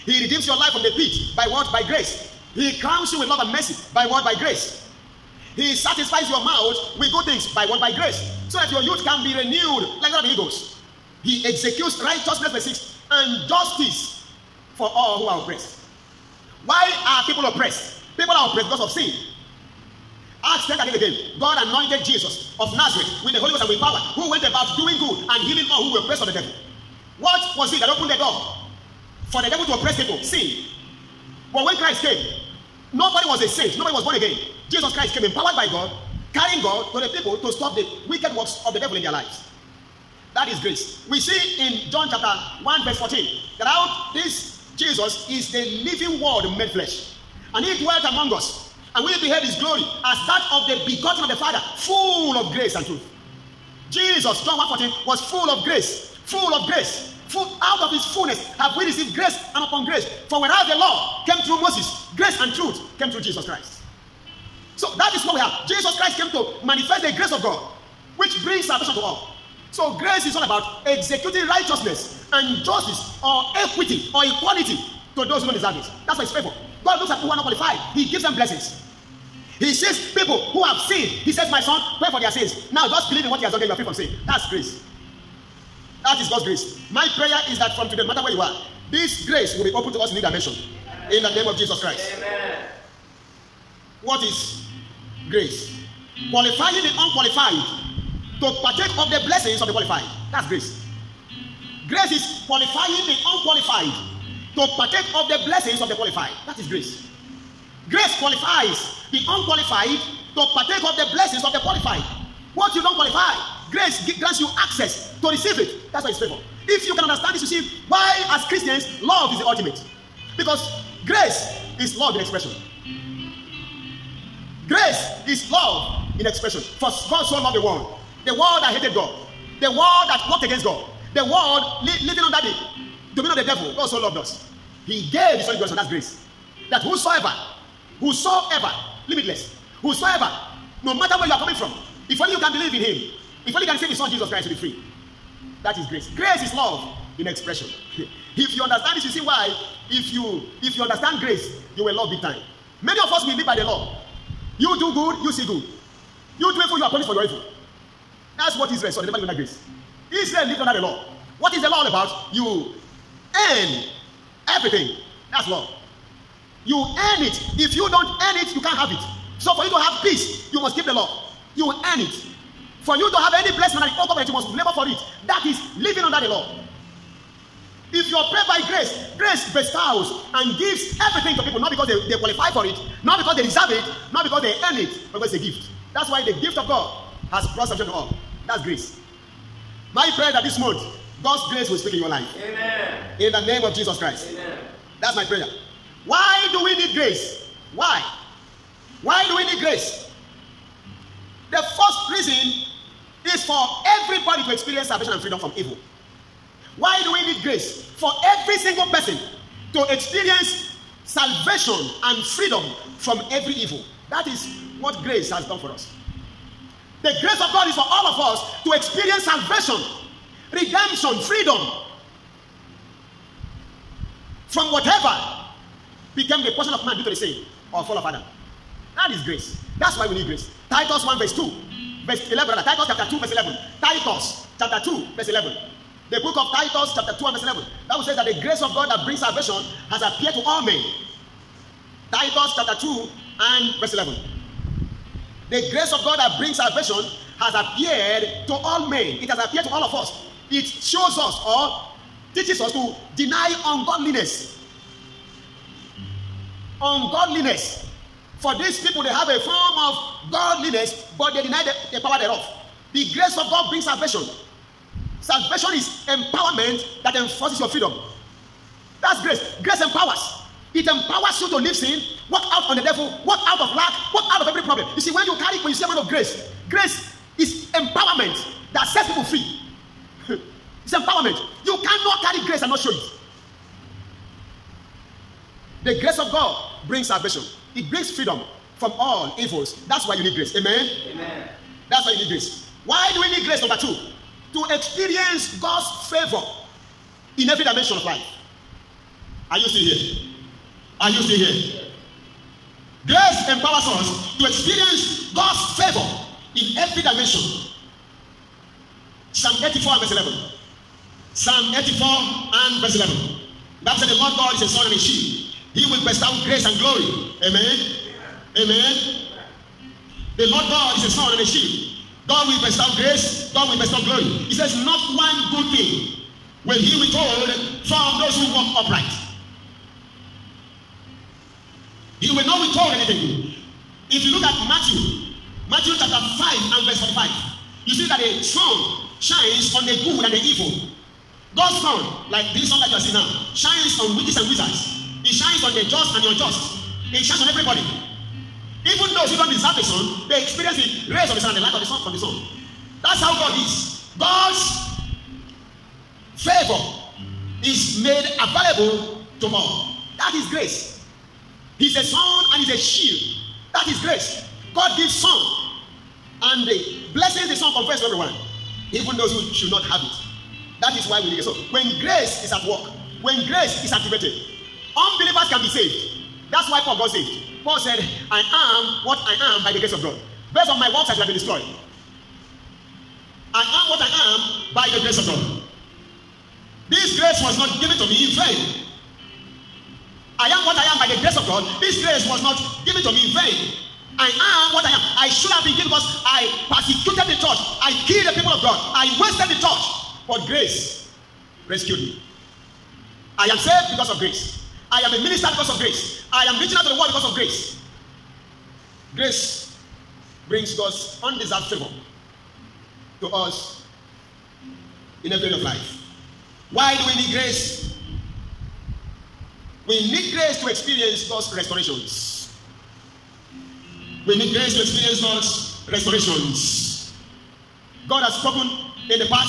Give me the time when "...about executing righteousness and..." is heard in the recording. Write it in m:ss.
1:10.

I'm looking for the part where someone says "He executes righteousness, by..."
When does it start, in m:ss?
0:11.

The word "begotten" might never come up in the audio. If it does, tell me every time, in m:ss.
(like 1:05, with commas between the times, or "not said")
0:50, 2:15.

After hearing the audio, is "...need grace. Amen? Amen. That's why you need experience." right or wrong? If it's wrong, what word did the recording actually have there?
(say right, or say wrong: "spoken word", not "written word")
wrong: "grace", not "experience".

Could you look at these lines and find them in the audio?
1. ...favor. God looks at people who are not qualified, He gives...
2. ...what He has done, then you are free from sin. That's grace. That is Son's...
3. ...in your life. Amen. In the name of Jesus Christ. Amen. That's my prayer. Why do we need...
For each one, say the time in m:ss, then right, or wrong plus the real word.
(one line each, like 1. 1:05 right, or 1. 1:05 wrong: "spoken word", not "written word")
1. 1:16 right
2. 1:23 wrong: "God", not "Son"
3. 3:11 right.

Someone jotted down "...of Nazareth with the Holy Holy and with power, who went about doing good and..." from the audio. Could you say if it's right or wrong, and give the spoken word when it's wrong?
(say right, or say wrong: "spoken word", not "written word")
wrong: "Ghost", not "Holy".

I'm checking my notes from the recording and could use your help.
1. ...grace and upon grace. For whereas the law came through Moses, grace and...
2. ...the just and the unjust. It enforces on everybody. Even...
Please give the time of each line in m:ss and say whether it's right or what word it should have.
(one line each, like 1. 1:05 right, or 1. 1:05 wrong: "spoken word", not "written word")
1. 0:59 right
2. 5:45 wrong: "shines", not "enforces".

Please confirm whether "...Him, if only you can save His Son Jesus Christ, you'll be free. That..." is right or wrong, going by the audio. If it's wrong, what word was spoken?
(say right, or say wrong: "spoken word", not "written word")
right.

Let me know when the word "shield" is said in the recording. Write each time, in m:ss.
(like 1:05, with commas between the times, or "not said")
5:14, 5:21, 6:02.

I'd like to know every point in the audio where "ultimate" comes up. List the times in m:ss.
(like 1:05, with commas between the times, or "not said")
1:59.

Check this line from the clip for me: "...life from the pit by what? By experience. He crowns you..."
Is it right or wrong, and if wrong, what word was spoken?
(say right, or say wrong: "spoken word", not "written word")
wrong: "grace", not "experience".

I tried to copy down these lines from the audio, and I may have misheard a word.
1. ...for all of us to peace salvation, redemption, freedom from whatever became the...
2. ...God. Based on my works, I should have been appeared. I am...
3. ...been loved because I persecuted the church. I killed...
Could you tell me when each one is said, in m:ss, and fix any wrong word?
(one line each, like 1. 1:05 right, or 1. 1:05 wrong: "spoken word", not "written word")
1. 3:37 wrong: "experience", not "peace"
2. 6:20 wrong: "destroyed", not "appeared"
3. 6:35 wrong: "killed", not "loved".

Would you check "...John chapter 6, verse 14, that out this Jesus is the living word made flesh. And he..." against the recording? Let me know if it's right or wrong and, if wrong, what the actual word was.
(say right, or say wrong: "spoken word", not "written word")
wrong: "1", not "6".